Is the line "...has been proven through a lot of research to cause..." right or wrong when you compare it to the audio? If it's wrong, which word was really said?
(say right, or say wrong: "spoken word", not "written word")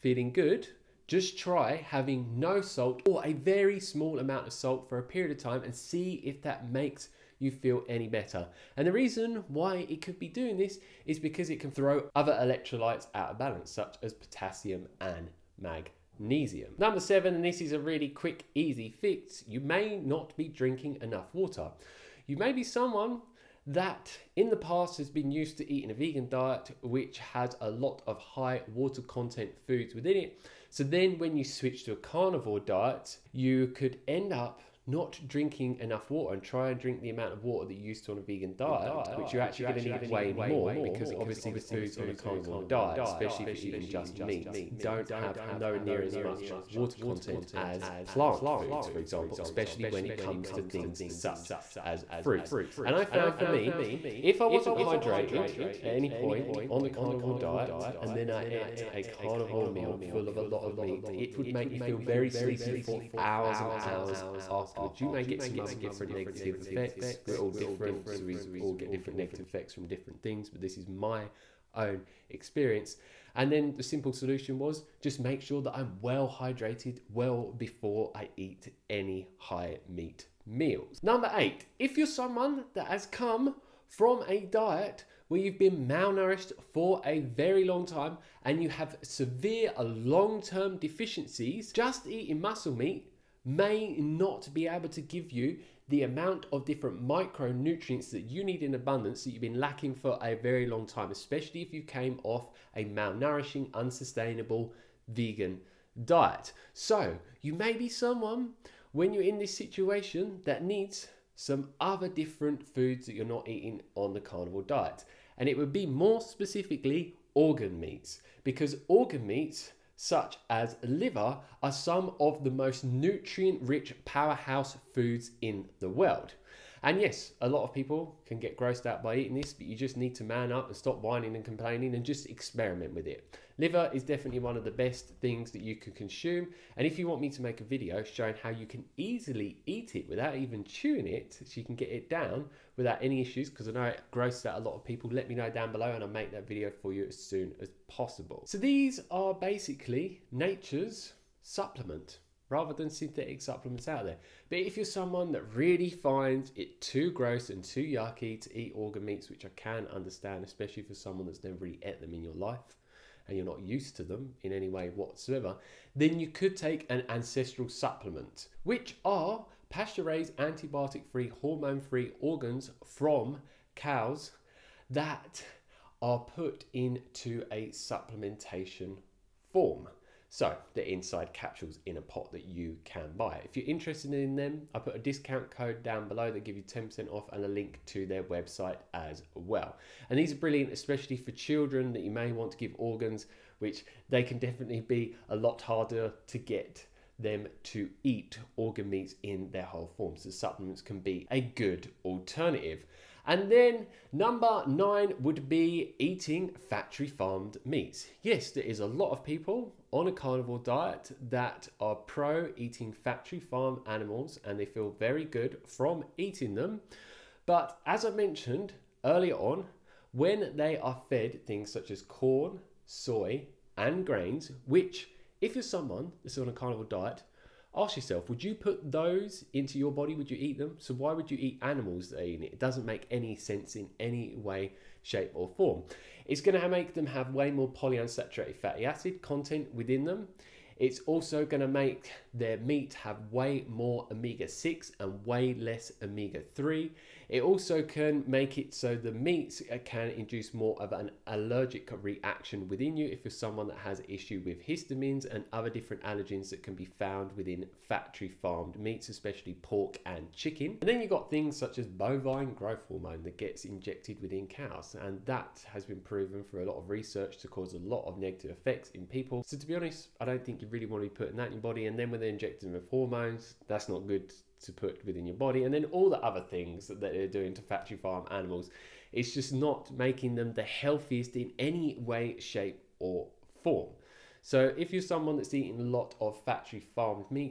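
right.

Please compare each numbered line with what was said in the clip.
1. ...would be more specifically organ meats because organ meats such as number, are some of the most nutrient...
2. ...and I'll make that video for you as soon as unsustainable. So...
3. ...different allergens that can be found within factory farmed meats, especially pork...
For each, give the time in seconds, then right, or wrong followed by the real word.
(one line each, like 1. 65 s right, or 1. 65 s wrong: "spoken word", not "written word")
1. 115 s wrong: "liver", not "number"
2. 145 s wrong: "possible", not "unsustainable"
3. 255 s right.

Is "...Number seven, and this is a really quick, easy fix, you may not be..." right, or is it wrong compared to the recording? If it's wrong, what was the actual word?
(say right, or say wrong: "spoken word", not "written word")
right.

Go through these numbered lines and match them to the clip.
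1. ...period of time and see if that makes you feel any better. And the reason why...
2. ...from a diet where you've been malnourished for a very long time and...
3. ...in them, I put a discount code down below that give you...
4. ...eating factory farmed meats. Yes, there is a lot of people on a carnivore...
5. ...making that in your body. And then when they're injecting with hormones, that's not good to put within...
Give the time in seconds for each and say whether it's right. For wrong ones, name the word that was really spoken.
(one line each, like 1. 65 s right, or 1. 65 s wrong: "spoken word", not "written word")
1. 5 s right
2. 83 s right
3. 184 s right
4. 205 s right
5. 271 s wrong: "putting", not "making".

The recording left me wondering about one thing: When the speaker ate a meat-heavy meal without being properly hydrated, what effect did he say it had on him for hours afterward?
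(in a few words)
Very sleepy.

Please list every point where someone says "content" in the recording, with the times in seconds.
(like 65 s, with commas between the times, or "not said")
29 s, 46 s, 239 s.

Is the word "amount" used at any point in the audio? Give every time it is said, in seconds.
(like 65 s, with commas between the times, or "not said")
4 s, 37 s, 96 s.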